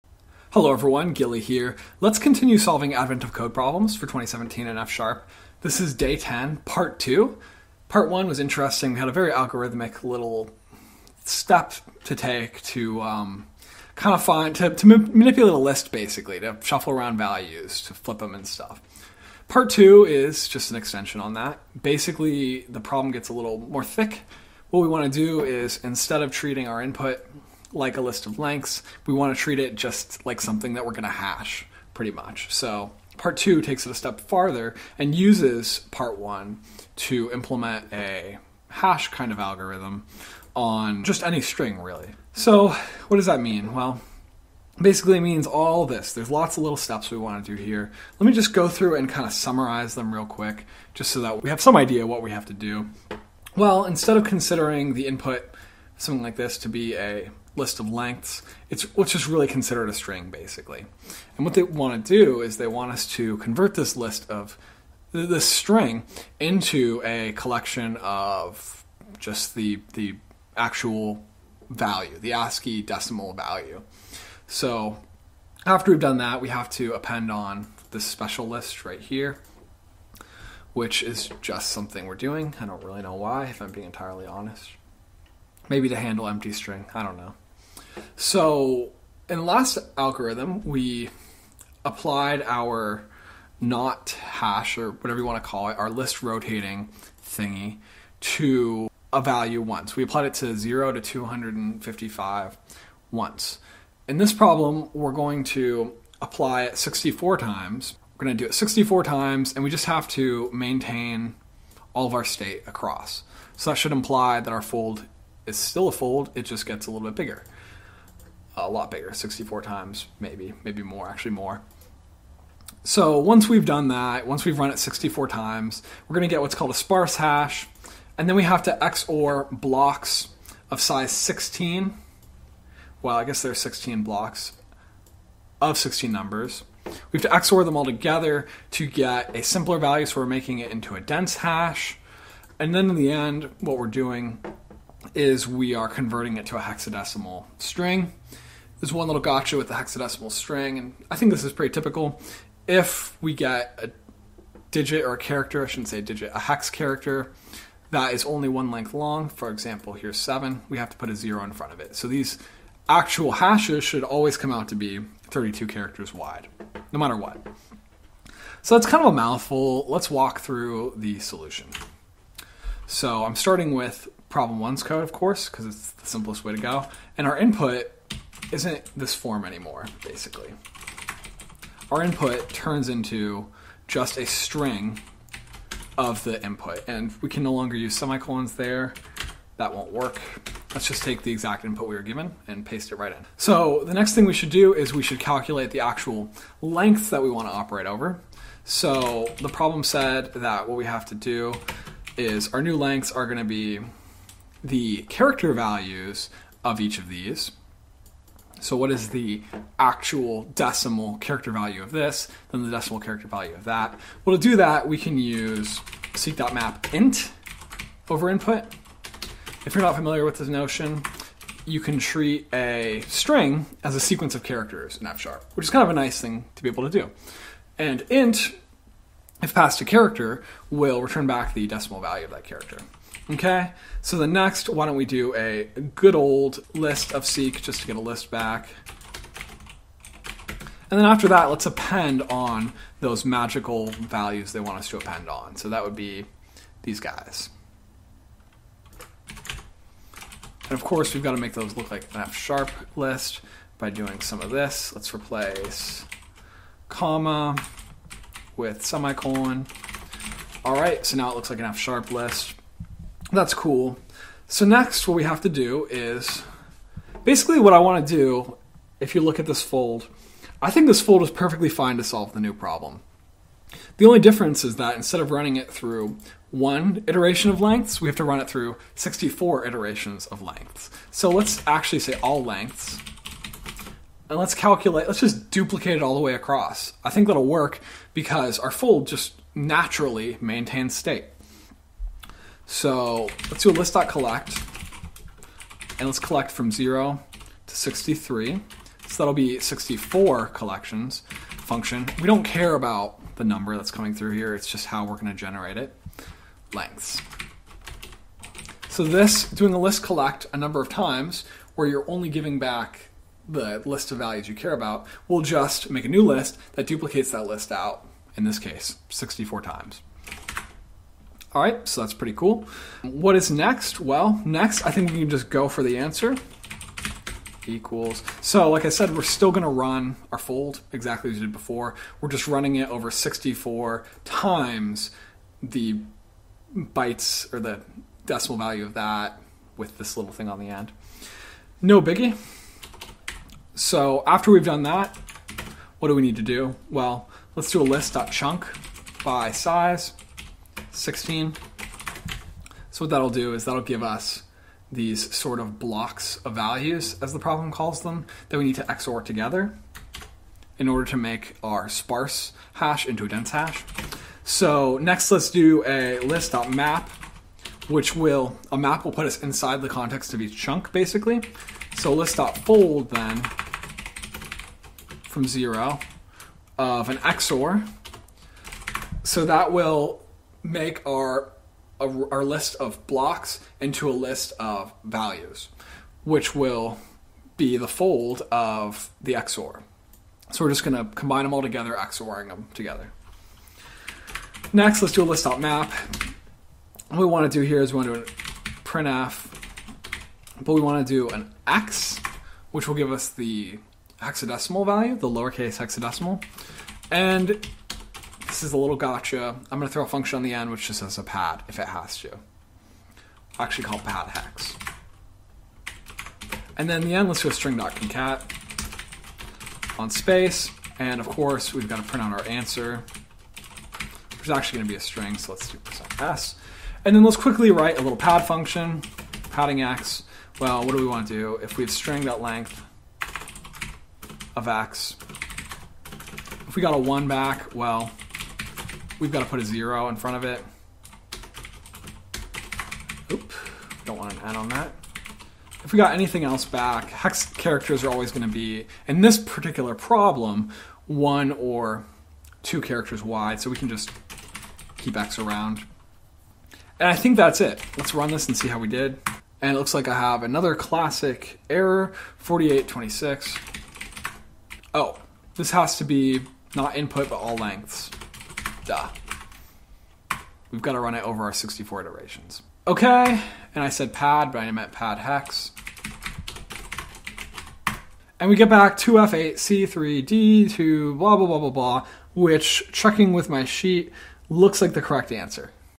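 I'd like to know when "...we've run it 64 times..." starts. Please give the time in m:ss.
2:04.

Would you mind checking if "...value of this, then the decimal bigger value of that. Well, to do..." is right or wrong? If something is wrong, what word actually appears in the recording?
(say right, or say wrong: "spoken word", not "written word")
wrong: "character", not "bigger".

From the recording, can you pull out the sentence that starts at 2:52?
So I'm starting with problem ones code, of course, because it's the simplest way to go.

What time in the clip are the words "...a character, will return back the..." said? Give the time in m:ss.
3:49.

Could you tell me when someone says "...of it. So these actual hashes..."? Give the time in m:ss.
2:41.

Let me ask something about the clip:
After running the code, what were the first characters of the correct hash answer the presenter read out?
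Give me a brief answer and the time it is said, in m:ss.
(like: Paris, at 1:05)
2F8, at 7:58.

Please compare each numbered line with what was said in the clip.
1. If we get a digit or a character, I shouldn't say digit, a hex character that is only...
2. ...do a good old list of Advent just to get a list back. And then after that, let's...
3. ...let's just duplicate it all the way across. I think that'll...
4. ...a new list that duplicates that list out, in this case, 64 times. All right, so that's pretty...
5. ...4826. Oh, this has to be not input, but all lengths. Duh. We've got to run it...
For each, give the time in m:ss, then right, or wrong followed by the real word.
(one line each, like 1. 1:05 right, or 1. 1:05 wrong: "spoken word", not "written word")
1. 2:32 right
2. 3:55 wrong: "Seq", not "Advent"
3. 4:45 right
4. 5:16 right
5. 7:42 right.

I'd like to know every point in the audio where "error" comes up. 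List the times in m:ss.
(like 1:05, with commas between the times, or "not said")
7:41.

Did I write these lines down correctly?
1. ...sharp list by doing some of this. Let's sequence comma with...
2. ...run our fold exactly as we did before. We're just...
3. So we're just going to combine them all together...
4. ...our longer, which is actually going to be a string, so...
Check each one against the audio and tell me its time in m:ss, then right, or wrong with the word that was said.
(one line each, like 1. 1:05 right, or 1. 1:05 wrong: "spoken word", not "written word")
1. 4:12 wrong: "replace", not "sequence"
2. 5:29 right
3. 6:30 right
4. 7:02 wrong: "answer", not "longer".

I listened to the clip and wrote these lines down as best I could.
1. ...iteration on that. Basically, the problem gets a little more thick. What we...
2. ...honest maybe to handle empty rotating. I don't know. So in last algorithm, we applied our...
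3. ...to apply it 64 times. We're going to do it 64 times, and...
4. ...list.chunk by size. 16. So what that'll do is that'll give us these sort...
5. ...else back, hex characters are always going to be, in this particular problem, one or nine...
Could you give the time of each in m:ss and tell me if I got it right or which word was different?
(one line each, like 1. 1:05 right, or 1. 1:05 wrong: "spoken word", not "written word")
1. 0:20 wrong: "extension", not "iteration"
2. 1:24 wrong: "string", not "rotating"
3. 1:45 right
4. 5:47 right
5. 7:26 wrong: "two", not "nine".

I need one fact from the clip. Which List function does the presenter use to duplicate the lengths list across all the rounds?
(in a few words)
List.collect.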